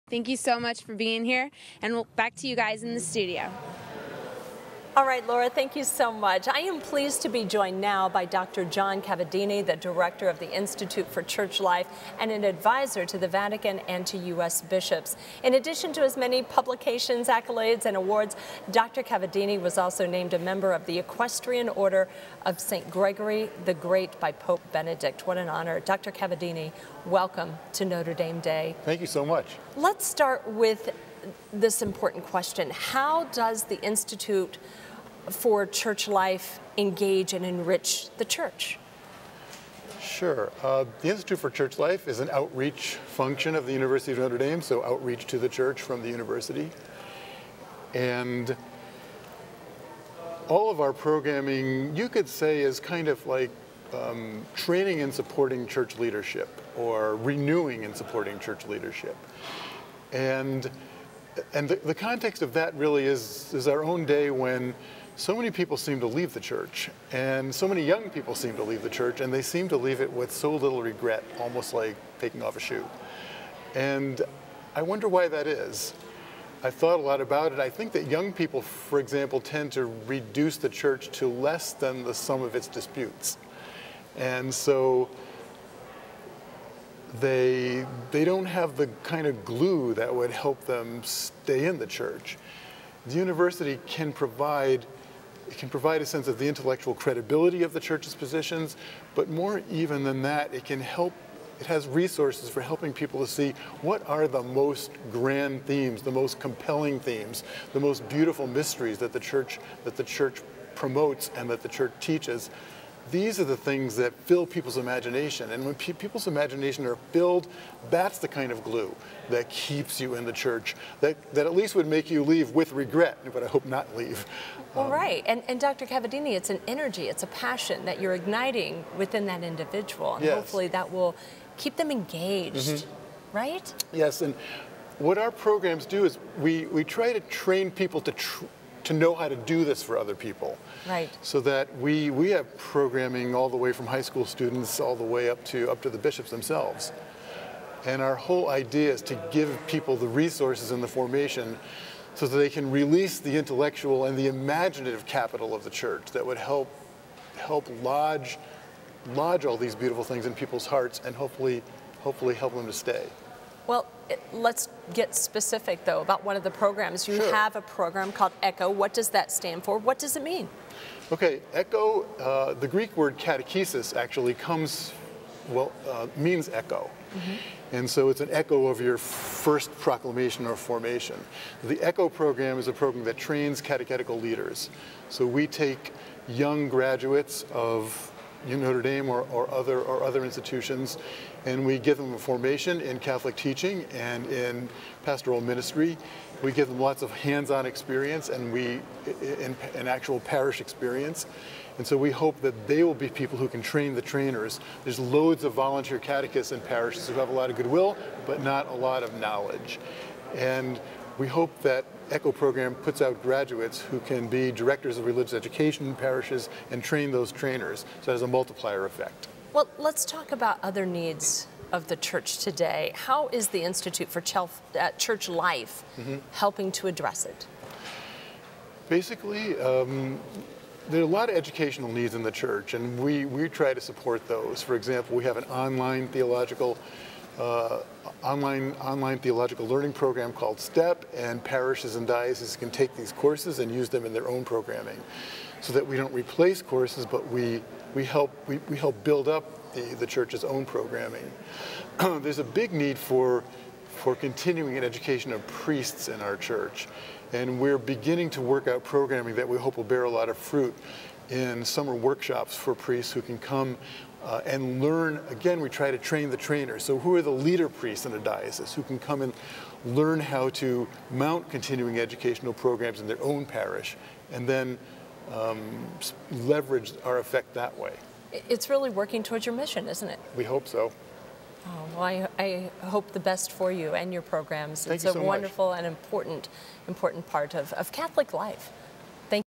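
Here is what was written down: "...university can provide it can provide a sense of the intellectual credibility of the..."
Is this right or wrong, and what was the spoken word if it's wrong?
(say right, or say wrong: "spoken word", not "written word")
right.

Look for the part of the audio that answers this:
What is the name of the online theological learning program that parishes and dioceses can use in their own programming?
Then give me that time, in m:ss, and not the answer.
4:00.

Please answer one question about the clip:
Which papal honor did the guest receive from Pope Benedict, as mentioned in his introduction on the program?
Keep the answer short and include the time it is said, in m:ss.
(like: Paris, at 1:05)
Equestrian Order of St. Gregory the Great, at 0:20.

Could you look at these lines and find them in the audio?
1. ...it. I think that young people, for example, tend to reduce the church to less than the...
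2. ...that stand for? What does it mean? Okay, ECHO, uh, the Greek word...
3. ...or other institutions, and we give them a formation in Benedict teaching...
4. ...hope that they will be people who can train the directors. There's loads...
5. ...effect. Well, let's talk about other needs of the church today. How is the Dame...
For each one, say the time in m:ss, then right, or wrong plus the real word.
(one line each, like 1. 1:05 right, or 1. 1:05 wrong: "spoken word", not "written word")
1. 1:17 right
2. 2:49 right
3. 3:09 wrong: "Catholic", not "Benedict"
4. 3:22 wrong: "trainers", not "directors"
5. 3:38 wrong: "Institute", not "Dame".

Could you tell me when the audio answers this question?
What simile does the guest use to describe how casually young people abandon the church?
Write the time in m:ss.
1:12.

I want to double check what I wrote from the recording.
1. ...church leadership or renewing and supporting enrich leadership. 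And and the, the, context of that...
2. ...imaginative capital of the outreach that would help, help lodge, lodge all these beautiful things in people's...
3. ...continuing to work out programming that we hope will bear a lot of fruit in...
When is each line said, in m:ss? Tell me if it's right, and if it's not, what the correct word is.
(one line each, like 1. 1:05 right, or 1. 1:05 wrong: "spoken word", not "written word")
1. 0:55 wrong: "church", not "enrich"
2. 2:34 wrong: "church", not "outreach"
3. 4:17 wrong: "beginning", not "continuing".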